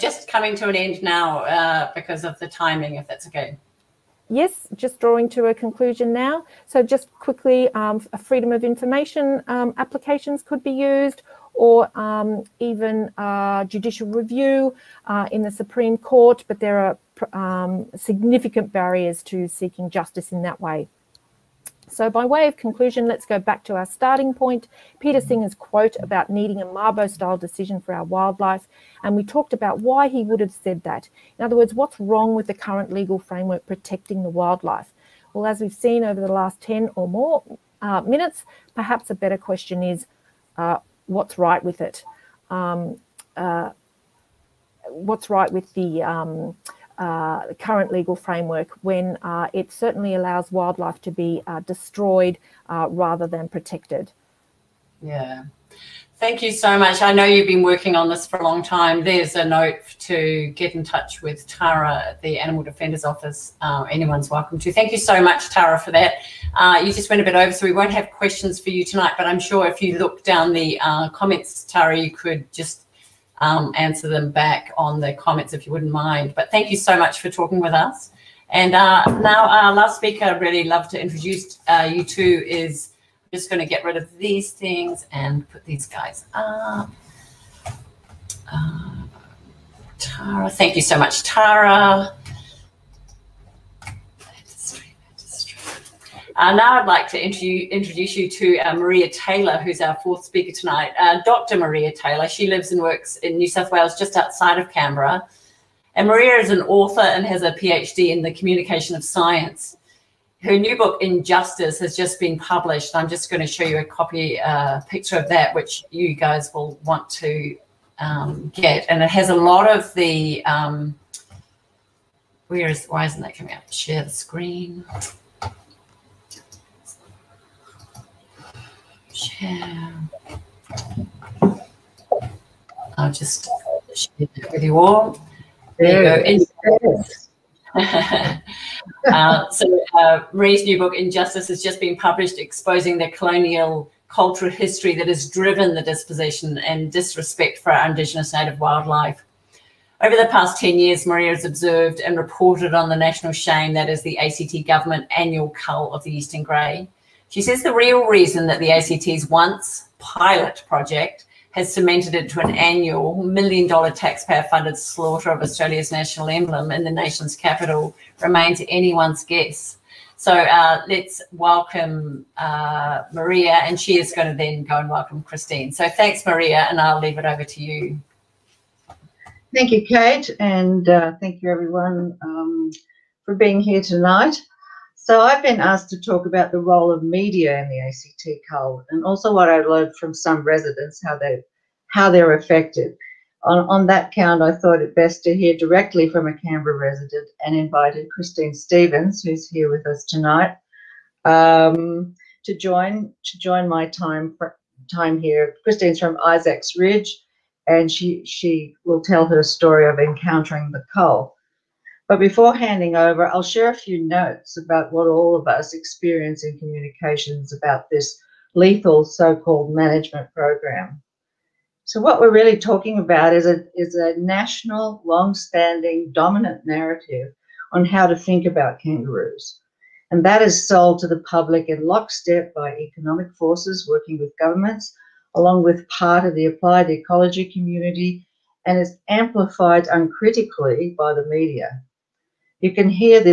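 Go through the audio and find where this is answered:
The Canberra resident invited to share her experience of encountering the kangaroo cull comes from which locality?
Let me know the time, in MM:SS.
03:26.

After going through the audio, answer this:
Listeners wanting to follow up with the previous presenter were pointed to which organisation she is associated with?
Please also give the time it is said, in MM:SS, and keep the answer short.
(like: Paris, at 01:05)
Animal Defenders Office, at 01:02.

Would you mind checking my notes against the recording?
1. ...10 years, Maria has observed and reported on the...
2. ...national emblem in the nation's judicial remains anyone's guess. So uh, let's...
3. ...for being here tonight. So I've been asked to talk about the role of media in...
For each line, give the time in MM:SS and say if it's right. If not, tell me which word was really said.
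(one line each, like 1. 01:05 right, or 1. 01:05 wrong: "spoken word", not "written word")
1. 02:30 right
2. 02:45 wrong: "capital", not "judicial"
3. 03:03 right.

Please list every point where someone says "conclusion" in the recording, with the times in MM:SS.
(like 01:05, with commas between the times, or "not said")
00:05, 00:22.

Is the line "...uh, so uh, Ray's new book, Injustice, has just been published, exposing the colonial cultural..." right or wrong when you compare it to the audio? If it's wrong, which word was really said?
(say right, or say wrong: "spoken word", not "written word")
right.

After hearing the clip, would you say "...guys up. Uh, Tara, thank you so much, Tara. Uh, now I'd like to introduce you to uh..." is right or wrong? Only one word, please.
right.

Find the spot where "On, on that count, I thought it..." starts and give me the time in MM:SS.
03:13.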